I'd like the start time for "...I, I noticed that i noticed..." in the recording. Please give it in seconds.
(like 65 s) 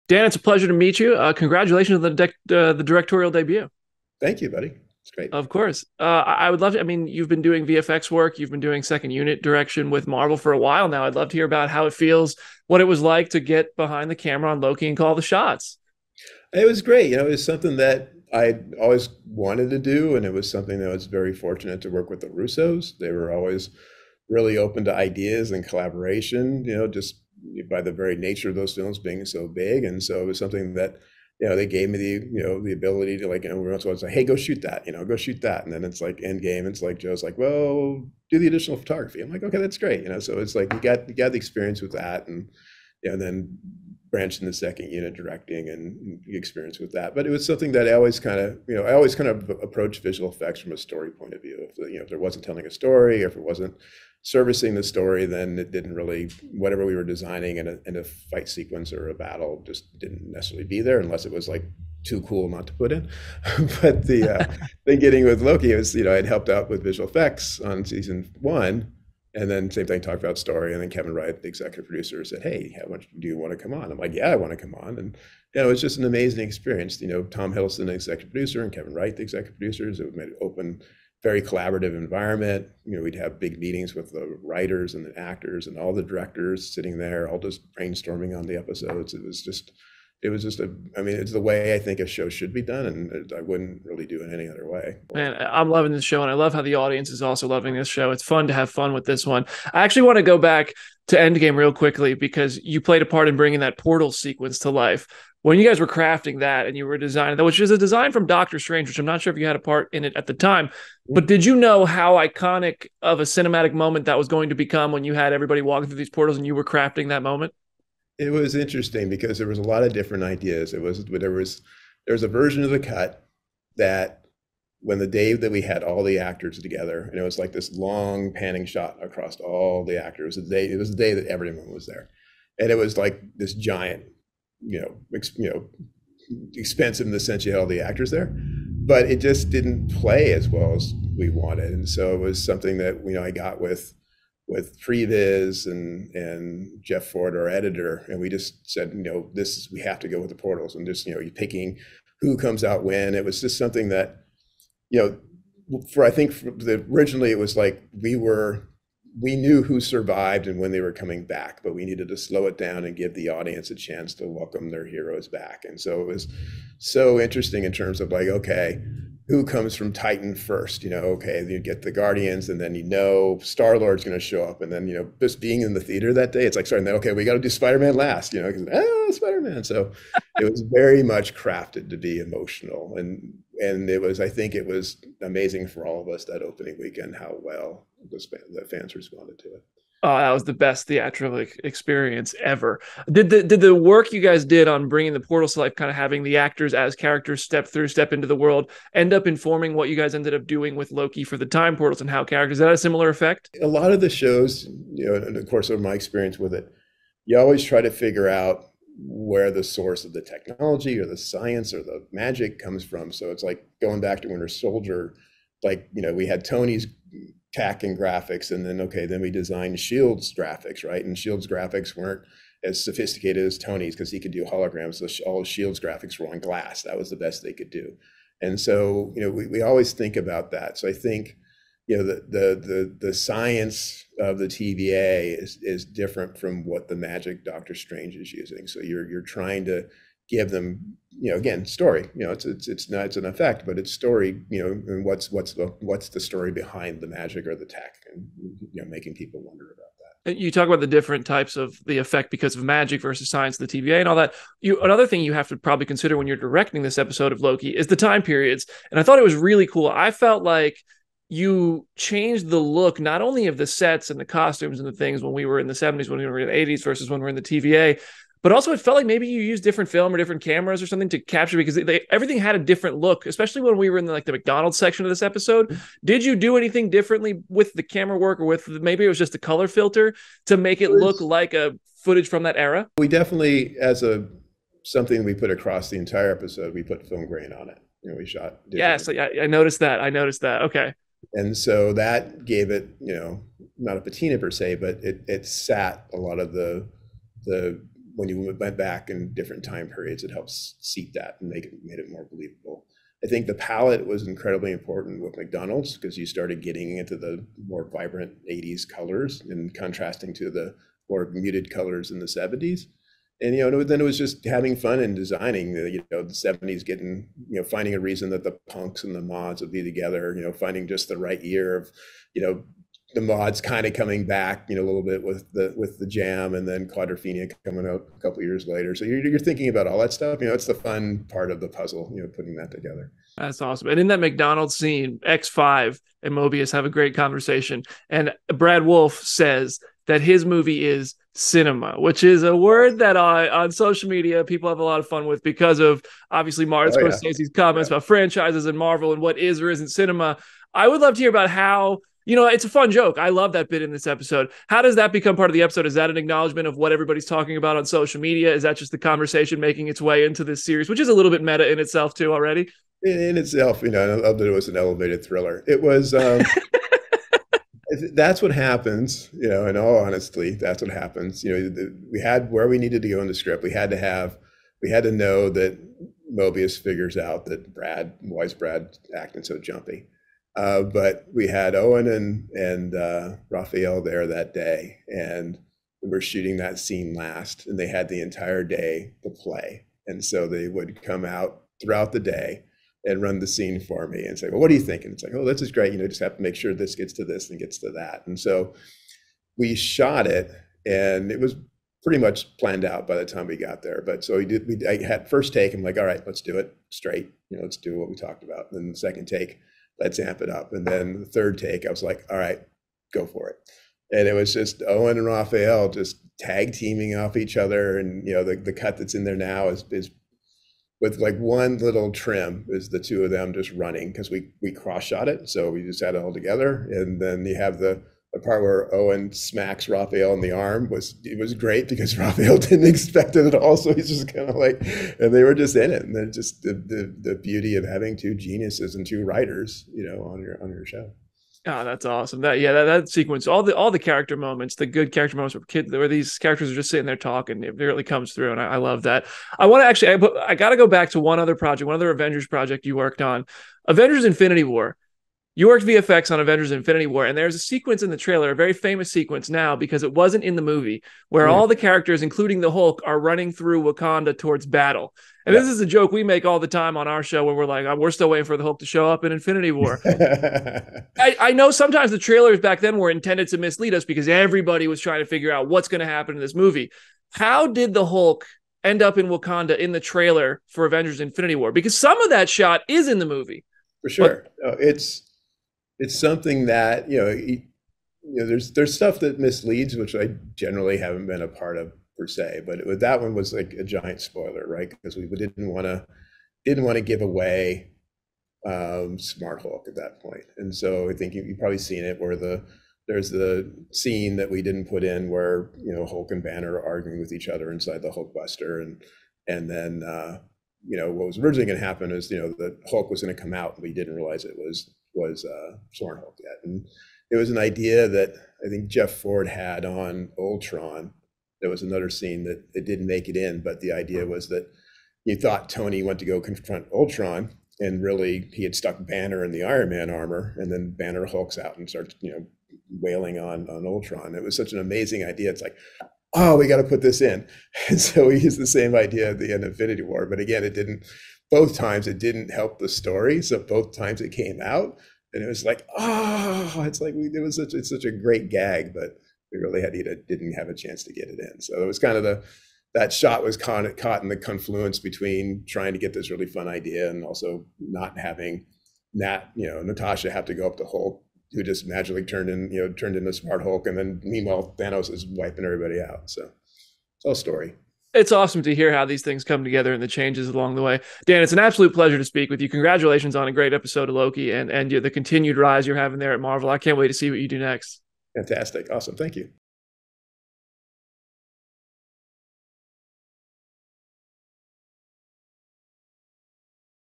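289 s.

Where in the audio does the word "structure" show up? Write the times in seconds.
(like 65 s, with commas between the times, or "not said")
not said.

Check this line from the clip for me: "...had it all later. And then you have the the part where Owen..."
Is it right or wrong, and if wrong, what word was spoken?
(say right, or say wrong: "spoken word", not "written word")
wrong: "together", not "later".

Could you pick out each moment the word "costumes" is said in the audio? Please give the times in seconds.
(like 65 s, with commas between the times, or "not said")
264 s.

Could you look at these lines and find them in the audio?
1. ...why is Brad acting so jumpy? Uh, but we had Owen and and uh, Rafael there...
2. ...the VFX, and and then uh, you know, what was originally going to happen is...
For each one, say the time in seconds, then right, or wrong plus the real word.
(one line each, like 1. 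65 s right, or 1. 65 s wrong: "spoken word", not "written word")
1. 378 s right
2. 508 s wrong: "Buster", not "VFX".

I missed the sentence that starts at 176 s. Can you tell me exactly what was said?
Okay, we got to do Spider Man last, you know, because ah, Spider Man.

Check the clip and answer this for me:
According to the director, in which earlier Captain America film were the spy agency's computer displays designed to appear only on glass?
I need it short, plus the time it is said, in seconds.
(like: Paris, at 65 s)
Winter Soldier, at 214 s.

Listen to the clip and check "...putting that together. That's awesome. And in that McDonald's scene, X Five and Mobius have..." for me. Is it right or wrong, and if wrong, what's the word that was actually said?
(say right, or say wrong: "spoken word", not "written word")
right.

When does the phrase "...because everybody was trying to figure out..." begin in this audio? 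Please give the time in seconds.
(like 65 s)
474 s.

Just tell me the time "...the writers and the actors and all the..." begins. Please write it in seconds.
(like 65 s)
84 s.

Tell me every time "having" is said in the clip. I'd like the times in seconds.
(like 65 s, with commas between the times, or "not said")
195 s, 314 s, 437 s, 558 s, 575 s.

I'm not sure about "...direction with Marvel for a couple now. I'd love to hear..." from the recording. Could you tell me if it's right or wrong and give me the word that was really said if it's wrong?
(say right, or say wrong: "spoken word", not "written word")
wrong: "while", not "couple".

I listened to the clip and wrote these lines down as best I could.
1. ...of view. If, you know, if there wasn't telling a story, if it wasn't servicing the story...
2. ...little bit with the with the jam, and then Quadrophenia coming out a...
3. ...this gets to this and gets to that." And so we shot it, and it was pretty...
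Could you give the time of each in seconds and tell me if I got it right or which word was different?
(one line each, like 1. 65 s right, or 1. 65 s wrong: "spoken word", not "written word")
1. 51 s right
2. 324 s right
3. 396 s right.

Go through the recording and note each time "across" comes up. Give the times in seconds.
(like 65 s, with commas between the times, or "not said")
129 s, 285 s.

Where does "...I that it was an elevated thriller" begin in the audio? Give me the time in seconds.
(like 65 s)
364 s.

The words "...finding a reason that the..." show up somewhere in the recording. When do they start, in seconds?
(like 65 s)
317 s.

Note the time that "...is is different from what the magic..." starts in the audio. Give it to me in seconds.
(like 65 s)
235 s.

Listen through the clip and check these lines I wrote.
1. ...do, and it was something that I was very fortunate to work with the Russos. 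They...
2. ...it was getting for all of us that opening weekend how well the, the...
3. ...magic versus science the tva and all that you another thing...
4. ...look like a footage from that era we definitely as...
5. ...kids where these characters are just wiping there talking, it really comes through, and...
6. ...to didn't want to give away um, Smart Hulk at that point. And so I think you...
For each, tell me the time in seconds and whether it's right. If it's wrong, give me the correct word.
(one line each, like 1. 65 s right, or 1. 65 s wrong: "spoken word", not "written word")
1. 19 s right
2. 184 s wrong: "amazing", not "getting"
3. 252 s right
4. 280 s right
5. 445 s wrong: "sitting", not "wiping"
6. 495 s right.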